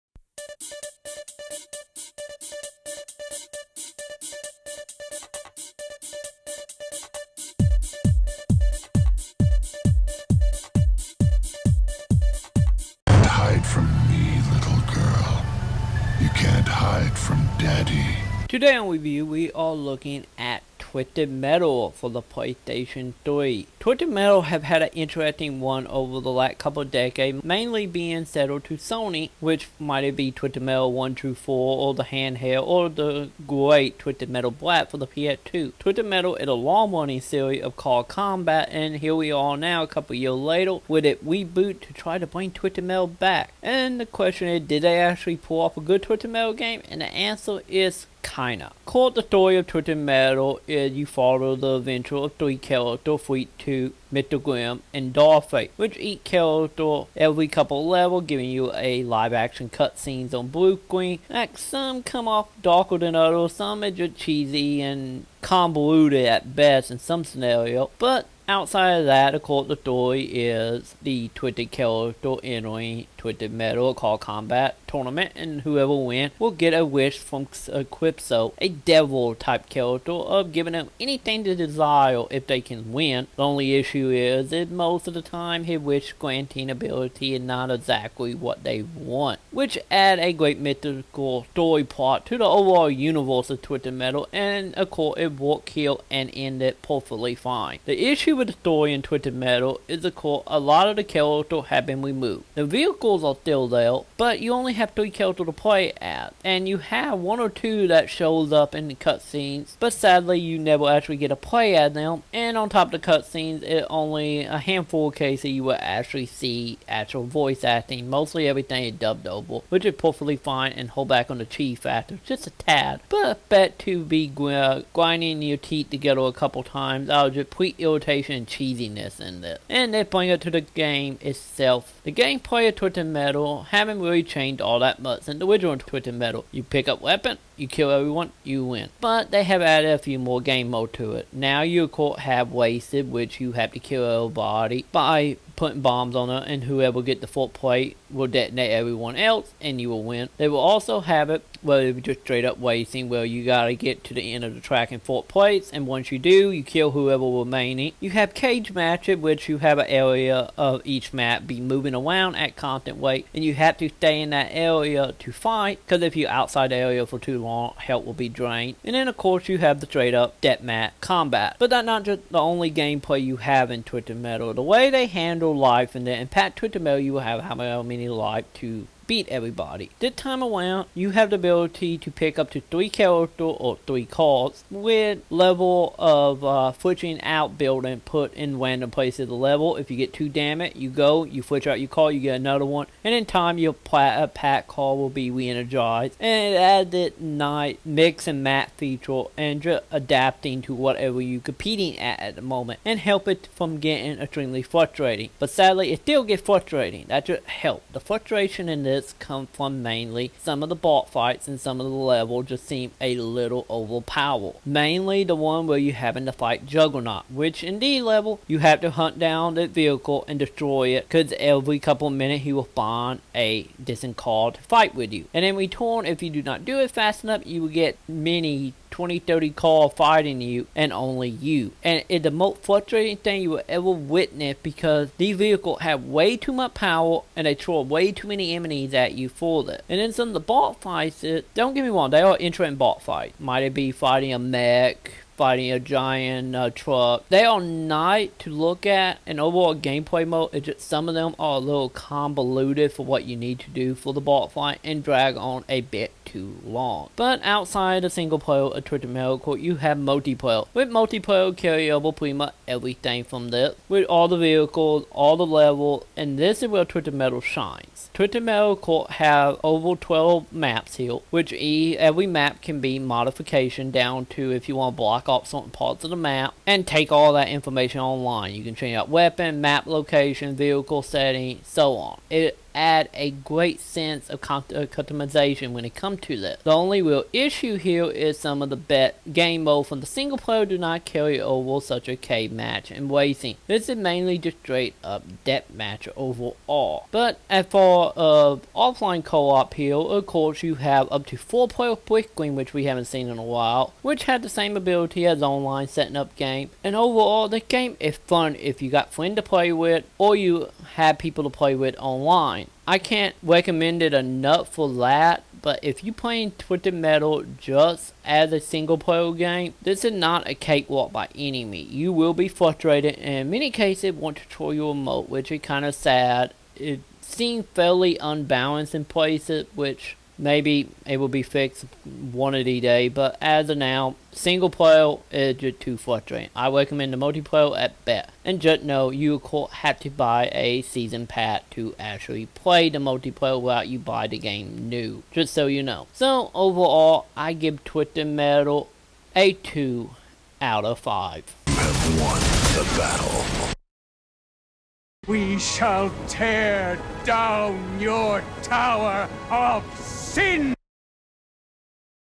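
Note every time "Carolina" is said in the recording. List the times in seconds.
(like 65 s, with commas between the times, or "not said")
not said.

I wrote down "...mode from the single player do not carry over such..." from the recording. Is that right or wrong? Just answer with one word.
right.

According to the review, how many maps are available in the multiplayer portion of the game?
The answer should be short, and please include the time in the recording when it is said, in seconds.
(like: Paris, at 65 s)
over 12, at 269 s.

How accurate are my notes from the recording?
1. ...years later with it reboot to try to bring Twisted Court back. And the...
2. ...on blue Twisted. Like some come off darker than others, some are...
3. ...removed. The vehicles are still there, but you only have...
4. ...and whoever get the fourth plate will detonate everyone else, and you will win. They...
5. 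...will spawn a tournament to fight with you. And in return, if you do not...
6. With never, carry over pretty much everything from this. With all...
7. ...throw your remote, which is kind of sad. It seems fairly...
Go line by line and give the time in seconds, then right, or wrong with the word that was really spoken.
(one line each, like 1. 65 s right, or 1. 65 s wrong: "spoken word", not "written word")
1. 40 s wrong: "Metal", not "Court"
2. 60 s wrong: "Queen", not "Twisted"
3. 102 s right
4. 146 s right
5. 222 s wrong: "distant", not "tournament"
6. 260 s wrong: "multiplayer", not "never"
7. 324 s right.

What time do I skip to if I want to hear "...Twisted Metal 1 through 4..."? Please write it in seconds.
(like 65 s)
30 s.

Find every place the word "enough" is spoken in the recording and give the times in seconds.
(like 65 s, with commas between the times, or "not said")
227 s, 314 s.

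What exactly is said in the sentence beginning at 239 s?
And then some of the bot fights, uh, don't get me wrong, they are interesting bot fights.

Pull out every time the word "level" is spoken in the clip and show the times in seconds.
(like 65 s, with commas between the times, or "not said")
57 s, 185 s, 189 s, 211 s, 218 s, 265 s.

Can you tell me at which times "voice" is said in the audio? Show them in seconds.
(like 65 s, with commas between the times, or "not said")
117 s.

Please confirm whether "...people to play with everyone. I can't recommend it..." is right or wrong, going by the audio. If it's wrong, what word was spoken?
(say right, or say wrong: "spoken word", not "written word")
wrong: "online", not "everyone".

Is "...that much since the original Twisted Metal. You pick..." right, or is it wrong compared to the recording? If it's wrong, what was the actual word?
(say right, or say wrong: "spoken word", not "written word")
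right.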